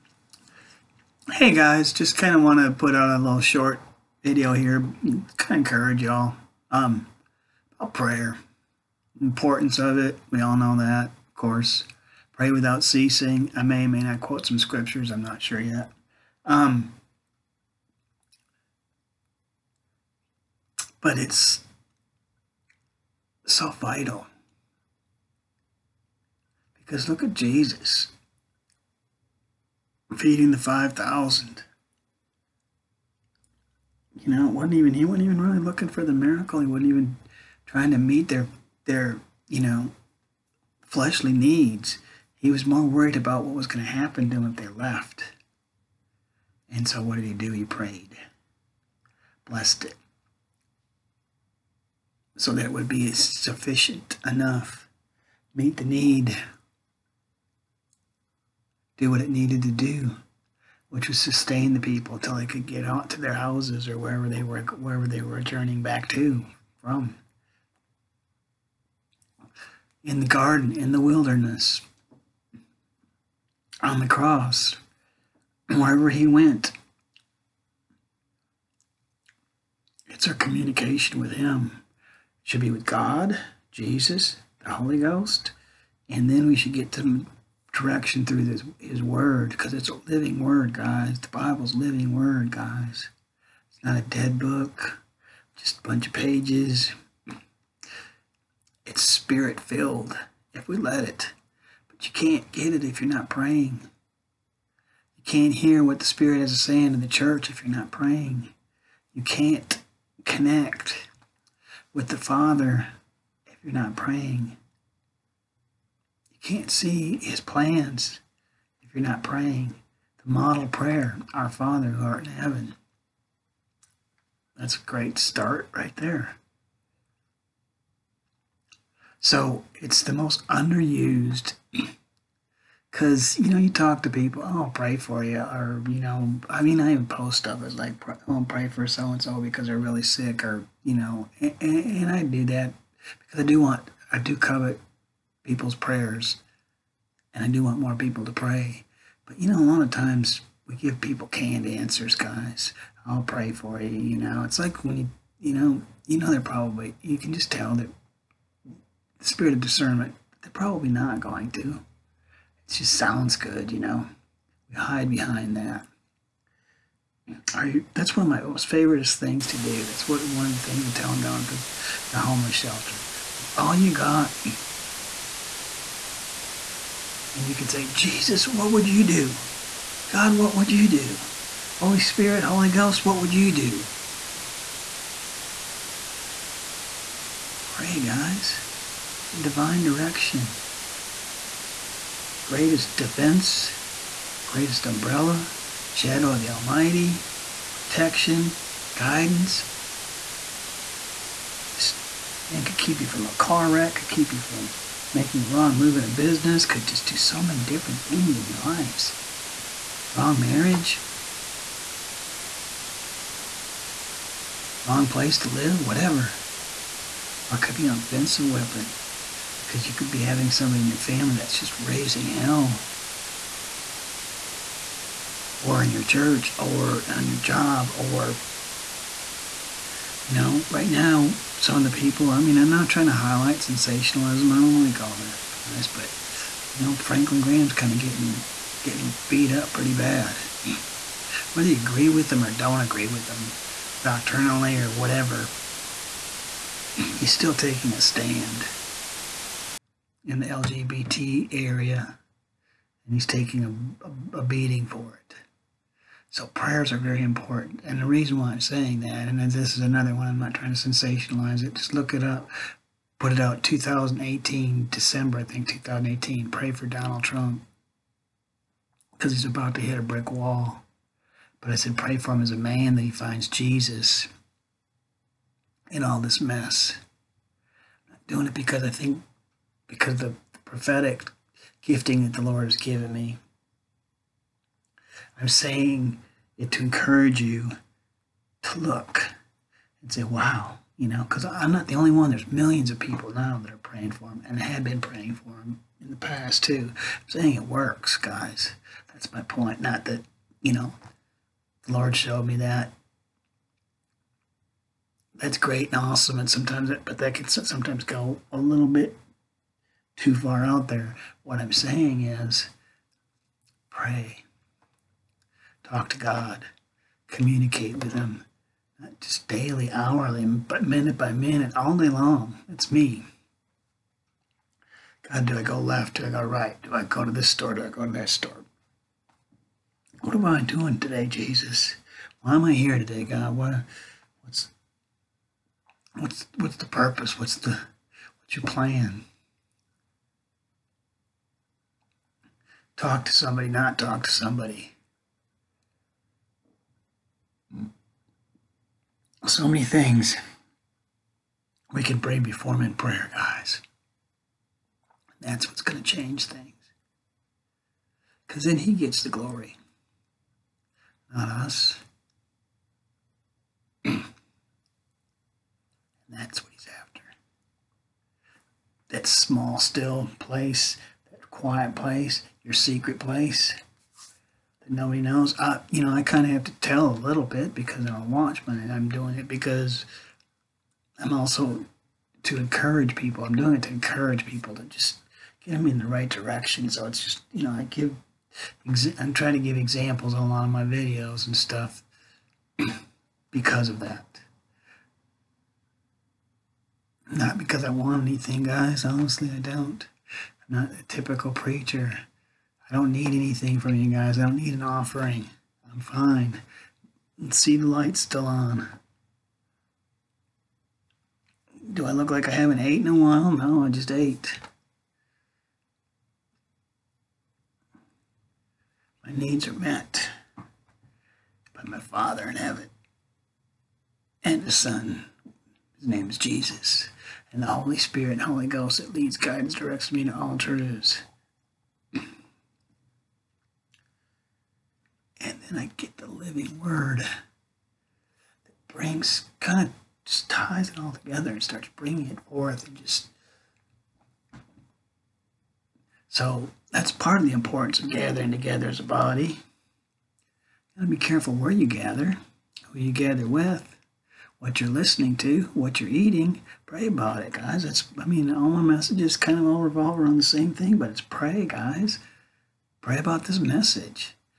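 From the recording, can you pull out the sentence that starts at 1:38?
It's spirit filled if we let it.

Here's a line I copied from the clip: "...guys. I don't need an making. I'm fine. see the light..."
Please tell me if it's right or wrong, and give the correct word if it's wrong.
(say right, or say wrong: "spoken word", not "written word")
wrong: "offering", not "making".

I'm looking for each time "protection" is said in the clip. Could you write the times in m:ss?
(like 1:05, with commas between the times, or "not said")
3:17.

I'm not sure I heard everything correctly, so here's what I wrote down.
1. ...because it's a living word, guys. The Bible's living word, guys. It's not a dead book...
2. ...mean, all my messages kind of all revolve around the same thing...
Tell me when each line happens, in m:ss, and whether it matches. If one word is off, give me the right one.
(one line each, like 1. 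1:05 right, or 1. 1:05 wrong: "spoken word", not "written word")
1. 1:29 right
2. 7:38 right.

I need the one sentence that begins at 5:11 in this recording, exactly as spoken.
What I'm saying is, pray talk to God, communicate with Him, not just daily, hourly, but minute by minute, all day long.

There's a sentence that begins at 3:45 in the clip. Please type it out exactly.
Or in your church, or on your job, or, you know, right now, some of the people.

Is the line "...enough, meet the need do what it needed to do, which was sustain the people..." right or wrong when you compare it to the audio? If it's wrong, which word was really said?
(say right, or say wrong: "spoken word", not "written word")
right.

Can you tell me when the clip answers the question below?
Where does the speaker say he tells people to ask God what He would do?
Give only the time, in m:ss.
2:52.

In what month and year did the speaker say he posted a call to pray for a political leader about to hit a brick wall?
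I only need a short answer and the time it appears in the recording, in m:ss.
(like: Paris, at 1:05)
December 2018, at 4:24.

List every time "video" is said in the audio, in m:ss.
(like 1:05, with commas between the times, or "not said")
0:04, 6:30.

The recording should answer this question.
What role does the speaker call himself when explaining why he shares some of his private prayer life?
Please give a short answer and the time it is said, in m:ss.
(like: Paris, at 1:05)
a watchman, at 6:18.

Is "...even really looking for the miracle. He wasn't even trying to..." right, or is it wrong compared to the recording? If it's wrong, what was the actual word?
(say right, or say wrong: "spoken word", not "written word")
right.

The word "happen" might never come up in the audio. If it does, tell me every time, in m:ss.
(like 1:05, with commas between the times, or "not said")
0:43.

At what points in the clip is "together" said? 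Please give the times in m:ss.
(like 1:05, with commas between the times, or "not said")
7:21, 7:28.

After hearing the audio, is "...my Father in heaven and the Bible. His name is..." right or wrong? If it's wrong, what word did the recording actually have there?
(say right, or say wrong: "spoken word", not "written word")
wrong: "Son", not "Bible".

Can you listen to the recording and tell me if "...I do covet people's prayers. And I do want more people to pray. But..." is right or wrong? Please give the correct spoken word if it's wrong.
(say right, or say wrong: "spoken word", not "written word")
right.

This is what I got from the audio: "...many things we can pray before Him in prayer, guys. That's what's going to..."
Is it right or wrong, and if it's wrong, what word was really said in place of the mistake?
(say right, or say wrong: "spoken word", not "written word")
right.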